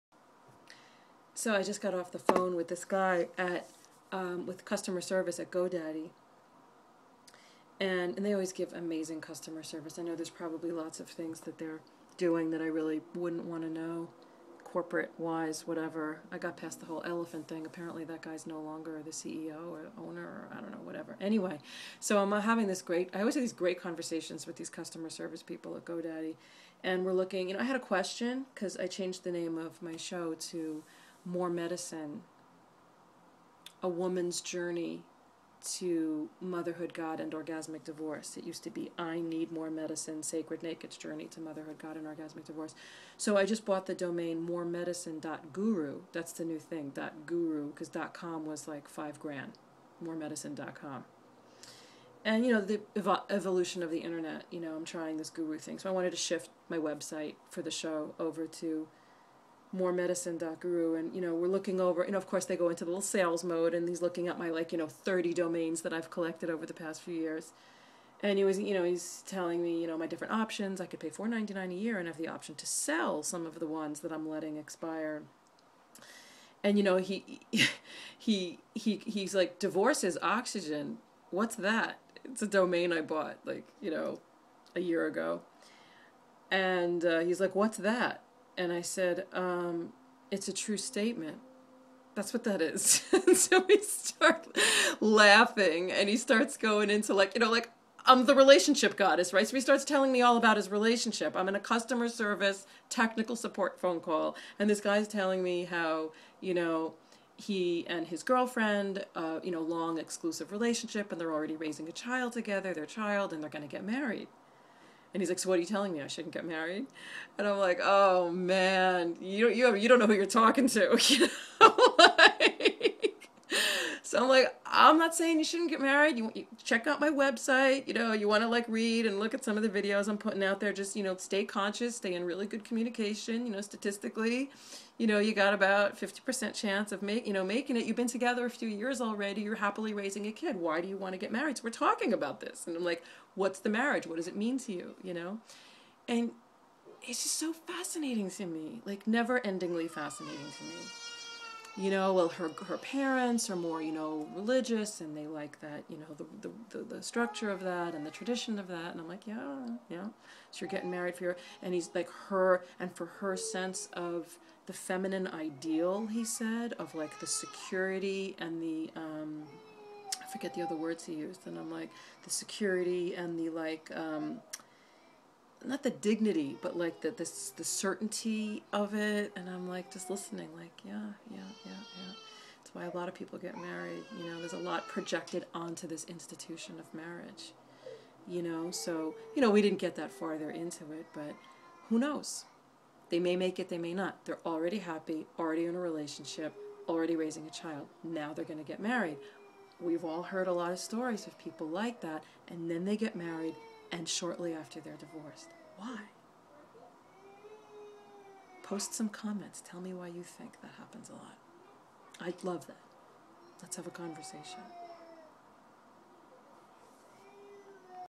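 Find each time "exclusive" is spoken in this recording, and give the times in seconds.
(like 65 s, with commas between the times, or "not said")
109 s.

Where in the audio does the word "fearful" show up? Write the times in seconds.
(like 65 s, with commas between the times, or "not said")
not said.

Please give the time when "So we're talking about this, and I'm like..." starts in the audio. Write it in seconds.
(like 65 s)
141 s.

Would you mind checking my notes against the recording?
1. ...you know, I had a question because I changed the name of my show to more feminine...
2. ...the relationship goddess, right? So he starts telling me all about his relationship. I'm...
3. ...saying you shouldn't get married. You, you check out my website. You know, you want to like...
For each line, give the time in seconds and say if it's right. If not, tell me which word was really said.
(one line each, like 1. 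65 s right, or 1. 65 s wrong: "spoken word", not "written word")
1. 27 s wrong: "medicine", not "feminine"
2. 98 s right
3. 125 s right.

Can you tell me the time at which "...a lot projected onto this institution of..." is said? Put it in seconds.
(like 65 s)
184 s.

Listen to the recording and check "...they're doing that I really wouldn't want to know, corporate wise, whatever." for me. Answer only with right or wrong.
right.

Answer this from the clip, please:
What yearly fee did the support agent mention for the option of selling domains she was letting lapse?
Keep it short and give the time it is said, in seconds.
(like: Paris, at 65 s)
4.99, at 71 s.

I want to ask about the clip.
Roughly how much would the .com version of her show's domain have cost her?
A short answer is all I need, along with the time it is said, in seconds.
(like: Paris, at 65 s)
5 grand, at 48 s.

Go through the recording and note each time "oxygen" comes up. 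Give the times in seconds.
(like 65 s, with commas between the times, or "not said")
80 s.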